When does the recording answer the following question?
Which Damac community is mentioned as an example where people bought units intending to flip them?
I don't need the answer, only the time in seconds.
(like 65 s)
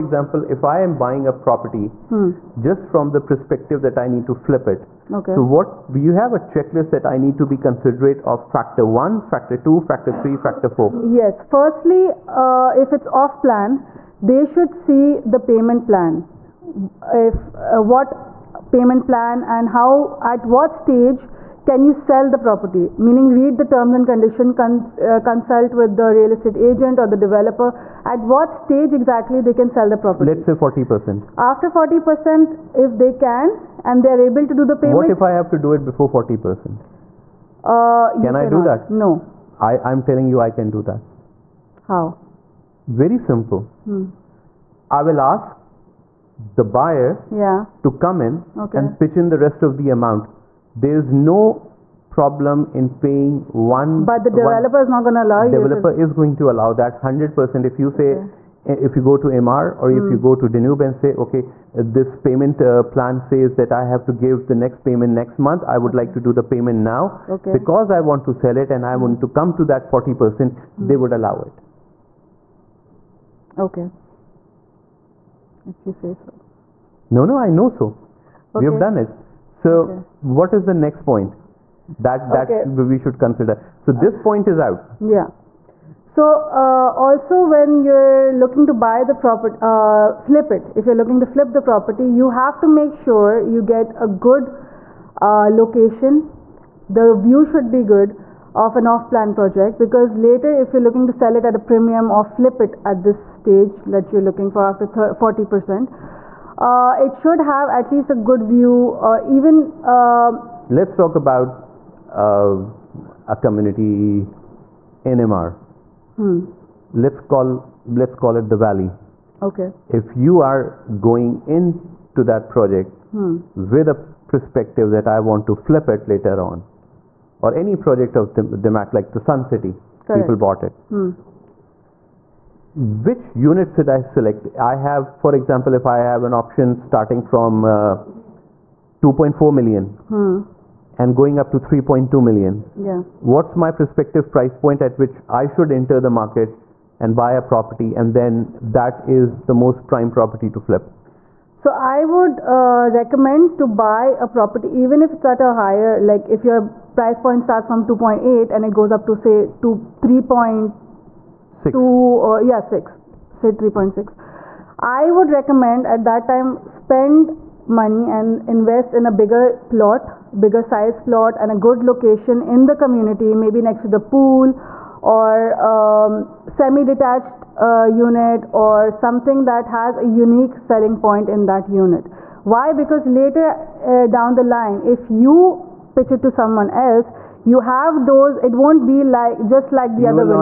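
129 s.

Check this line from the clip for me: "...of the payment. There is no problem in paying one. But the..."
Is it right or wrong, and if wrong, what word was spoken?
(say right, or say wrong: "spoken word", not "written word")
wrong: "amount", not "payment".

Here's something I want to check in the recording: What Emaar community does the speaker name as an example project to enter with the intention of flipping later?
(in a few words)
The Valley.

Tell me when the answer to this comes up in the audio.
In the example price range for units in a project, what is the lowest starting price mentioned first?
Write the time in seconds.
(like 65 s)
139 s.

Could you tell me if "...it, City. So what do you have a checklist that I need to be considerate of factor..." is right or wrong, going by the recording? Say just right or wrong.
wrong.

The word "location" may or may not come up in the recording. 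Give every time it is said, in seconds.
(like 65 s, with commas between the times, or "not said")
95 s, 171 s.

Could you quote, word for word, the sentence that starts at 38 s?
i do that no i i'm telling you i can do that how very simple hmm.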